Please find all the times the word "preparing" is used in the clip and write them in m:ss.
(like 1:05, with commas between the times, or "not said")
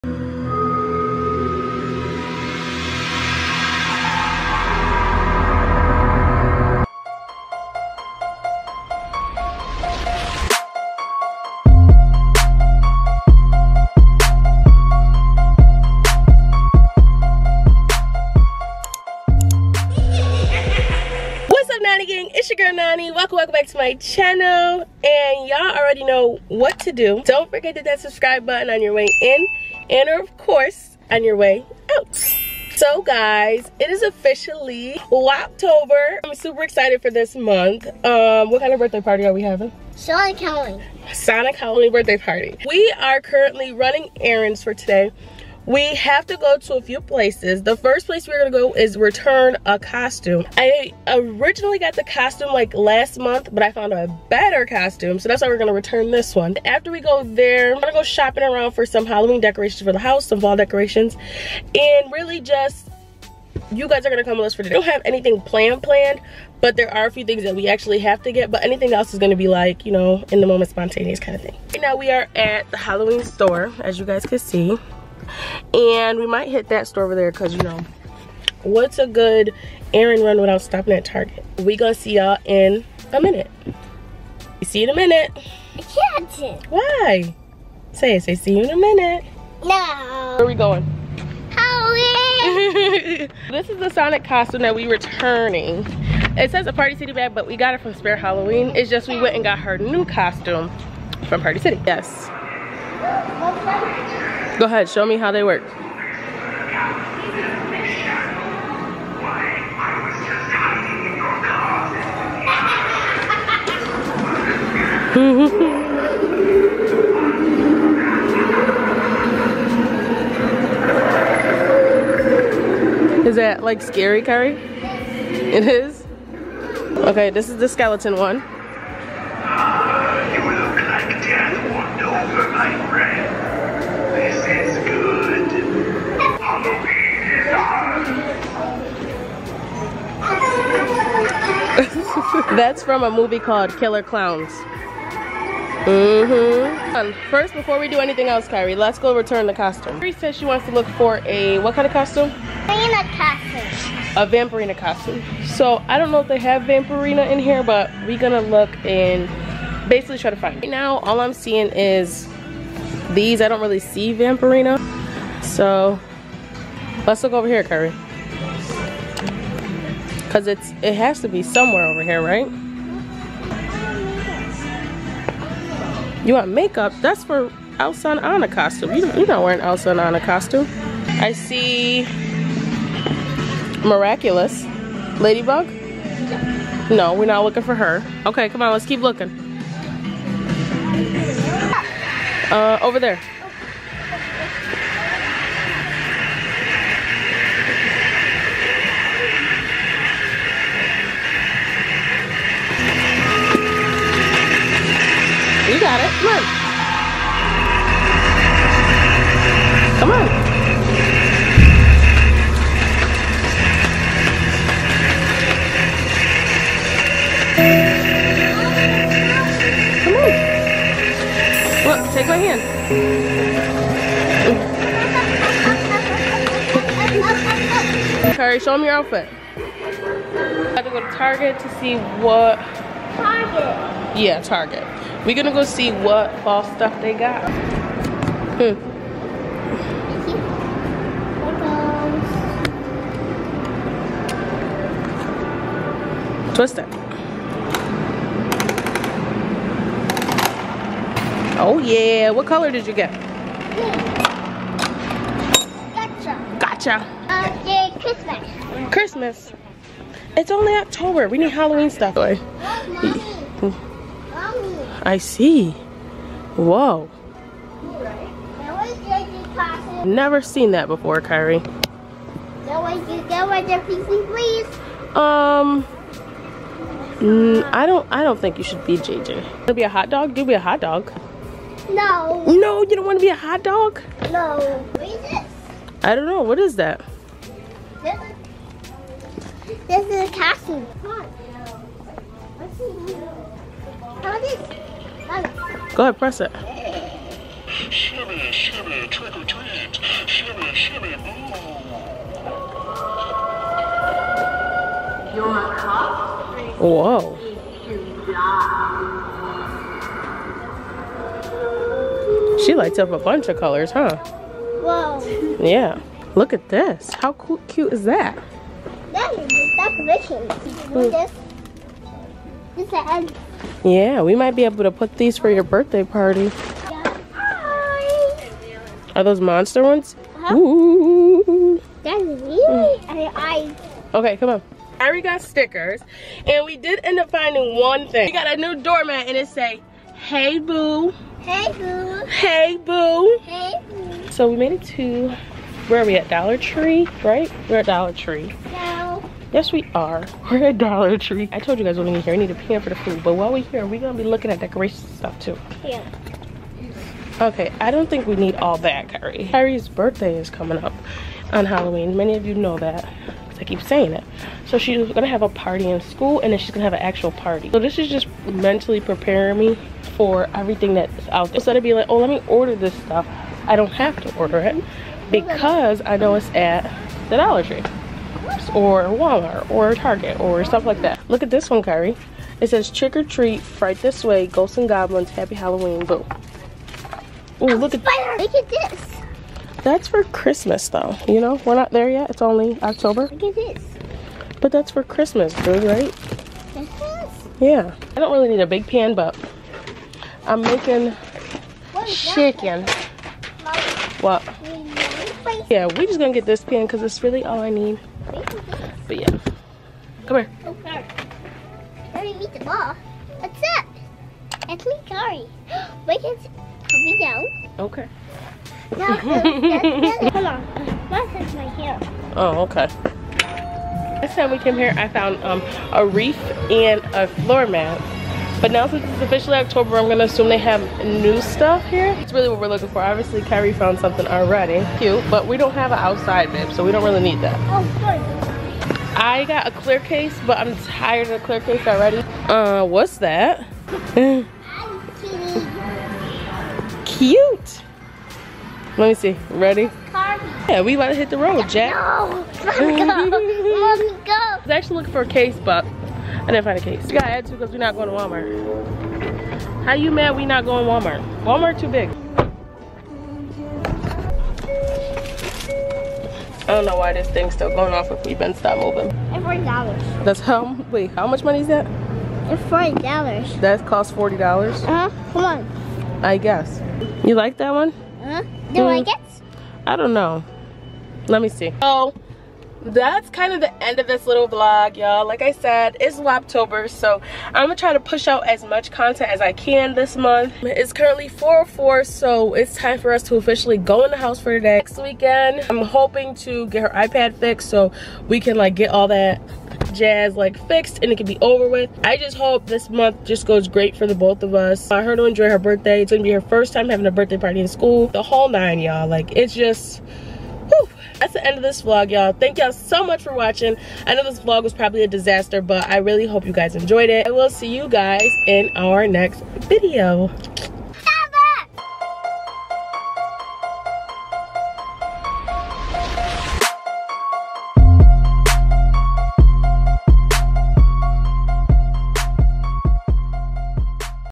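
6:08.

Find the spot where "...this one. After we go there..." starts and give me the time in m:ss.
0:56.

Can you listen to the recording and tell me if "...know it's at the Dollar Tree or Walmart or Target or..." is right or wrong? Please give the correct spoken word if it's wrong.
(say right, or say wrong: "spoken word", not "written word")
right.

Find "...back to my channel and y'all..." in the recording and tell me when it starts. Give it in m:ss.
0:23.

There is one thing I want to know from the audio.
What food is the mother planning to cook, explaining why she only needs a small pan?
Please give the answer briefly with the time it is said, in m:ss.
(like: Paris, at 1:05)
Chicken, at 6:40.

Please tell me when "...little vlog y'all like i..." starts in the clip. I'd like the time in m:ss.
8:04.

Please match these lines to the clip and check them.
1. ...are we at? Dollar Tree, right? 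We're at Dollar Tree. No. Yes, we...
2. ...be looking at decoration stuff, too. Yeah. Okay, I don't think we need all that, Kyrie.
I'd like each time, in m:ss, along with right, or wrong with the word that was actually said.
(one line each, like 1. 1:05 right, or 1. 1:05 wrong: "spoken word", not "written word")
1. 5:46 right
2. 5:54 right.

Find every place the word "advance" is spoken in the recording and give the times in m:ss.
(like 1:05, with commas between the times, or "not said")
not said.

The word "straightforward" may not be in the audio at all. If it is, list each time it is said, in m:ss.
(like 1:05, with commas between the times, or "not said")
not said.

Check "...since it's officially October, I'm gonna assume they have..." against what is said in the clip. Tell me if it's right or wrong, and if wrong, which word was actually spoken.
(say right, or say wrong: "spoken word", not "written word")
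right.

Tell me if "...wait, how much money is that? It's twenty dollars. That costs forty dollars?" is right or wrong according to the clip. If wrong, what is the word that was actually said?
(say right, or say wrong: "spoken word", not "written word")
wrong: "forty", not "twenty".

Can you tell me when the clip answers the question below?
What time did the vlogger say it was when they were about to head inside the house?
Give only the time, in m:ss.
8:11.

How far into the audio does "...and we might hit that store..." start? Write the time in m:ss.
1:15.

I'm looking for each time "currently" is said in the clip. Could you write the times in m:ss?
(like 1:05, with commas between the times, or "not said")
0:43, 8:10.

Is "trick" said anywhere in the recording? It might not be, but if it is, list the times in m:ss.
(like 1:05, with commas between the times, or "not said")
4:59, 6:22.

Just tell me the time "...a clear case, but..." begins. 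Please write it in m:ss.
7:19.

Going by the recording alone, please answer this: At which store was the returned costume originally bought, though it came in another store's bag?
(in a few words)
Spirit Halloween.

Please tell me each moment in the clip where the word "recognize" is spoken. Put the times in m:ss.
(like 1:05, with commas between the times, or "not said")
not said.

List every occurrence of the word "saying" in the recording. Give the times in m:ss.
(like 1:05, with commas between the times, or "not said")
6:03.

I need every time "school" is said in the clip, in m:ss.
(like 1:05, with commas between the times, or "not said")
6:06, 8:27.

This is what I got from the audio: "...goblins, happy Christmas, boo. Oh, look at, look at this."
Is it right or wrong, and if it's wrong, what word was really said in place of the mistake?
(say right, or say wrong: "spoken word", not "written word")
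wrong: "Halloween", not "Christmas".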